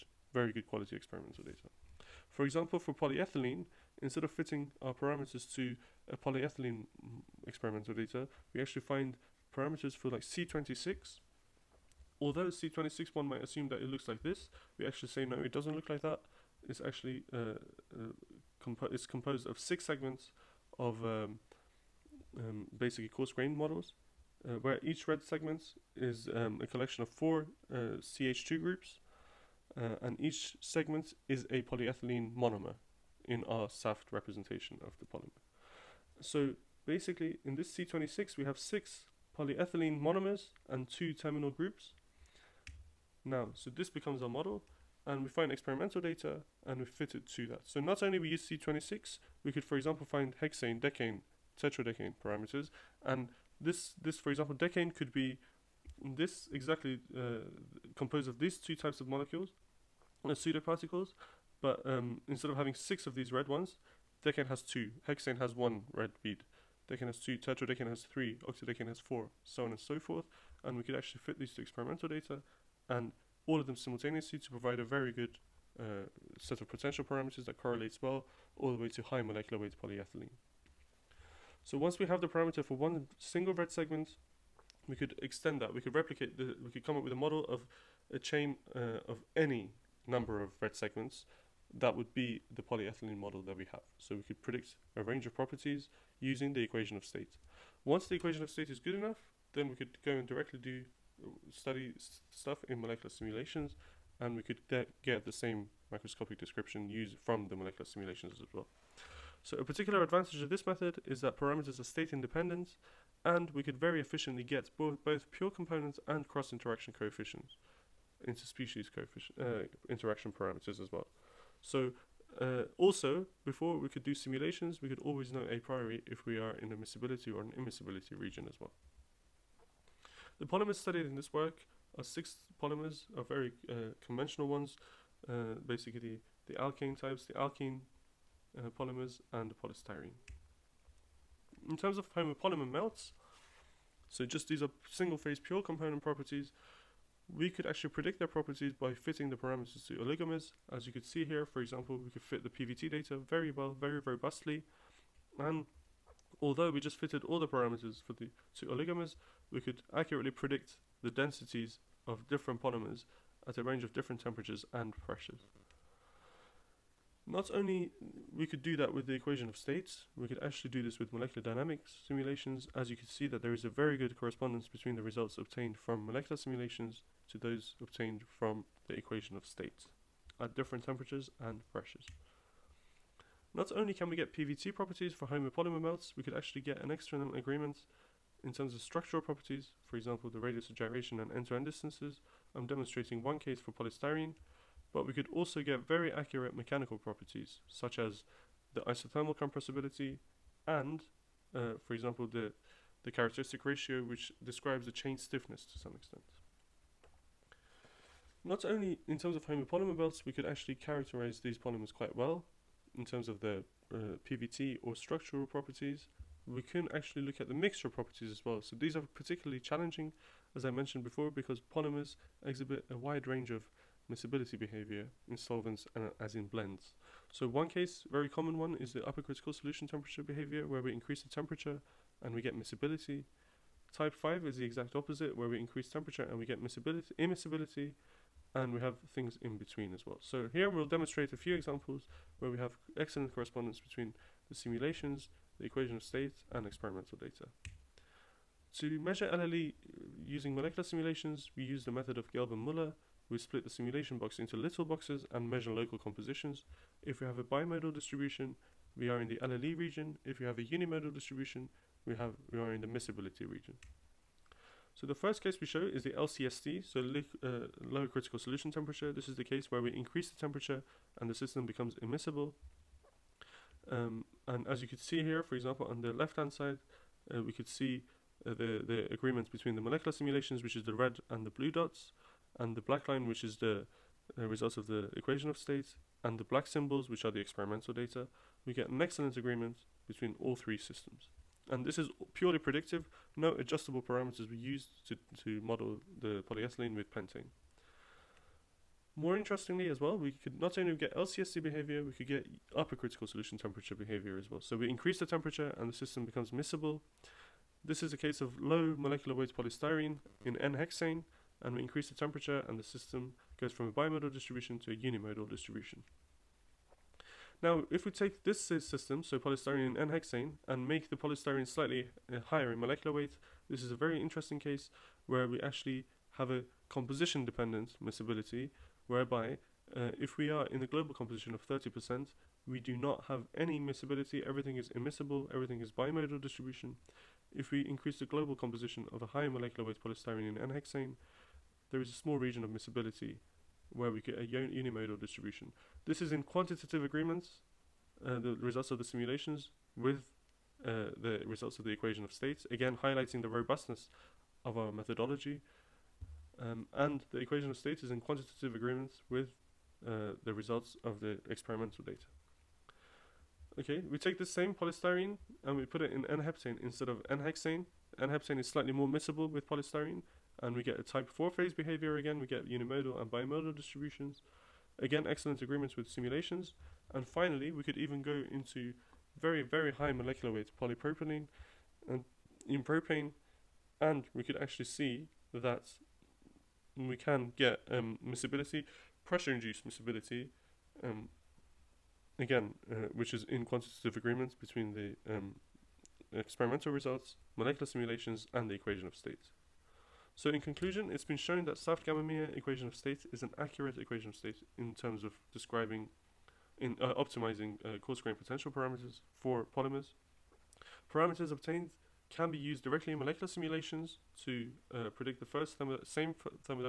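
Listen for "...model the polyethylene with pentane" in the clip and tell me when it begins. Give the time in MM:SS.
04:55.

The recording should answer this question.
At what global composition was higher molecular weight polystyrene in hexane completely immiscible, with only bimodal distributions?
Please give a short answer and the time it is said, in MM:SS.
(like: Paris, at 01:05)
30%, at 05:31.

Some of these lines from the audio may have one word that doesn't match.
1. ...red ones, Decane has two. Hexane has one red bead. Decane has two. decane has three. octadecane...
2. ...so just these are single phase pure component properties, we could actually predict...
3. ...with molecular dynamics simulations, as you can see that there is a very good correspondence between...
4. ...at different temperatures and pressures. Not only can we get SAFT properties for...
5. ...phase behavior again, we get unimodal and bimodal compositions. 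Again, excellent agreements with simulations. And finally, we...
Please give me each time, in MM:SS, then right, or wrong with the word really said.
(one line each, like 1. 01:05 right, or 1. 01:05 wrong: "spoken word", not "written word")
1. 01:03 right
2. 02:24 right
3. 02:50 right
4. 03:00 wrong: "PVT", not "SAFT"
5. 06:11 wrong: "distributions", not "compositions".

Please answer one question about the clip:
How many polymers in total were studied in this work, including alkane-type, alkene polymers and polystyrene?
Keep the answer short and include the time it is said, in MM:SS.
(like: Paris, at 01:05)
6, at 02:12.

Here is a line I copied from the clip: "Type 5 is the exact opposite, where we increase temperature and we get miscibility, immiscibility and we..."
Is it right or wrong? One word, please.
right.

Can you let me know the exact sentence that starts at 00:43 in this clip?
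Now, so this becomes our model and we find experimental data and we fit it to that.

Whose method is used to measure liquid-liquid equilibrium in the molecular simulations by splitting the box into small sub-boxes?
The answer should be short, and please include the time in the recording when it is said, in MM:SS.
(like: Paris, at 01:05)
Gelb and Muller, at 04:12.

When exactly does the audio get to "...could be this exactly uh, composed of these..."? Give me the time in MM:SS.
00:54.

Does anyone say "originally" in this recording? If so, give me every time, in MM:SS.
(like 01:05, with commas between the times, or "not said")
not said.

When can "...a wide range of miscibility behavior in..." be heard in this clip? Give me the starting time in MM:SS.
03:42.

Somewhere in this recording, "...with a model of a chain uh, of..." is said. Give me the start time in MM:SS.
01:27.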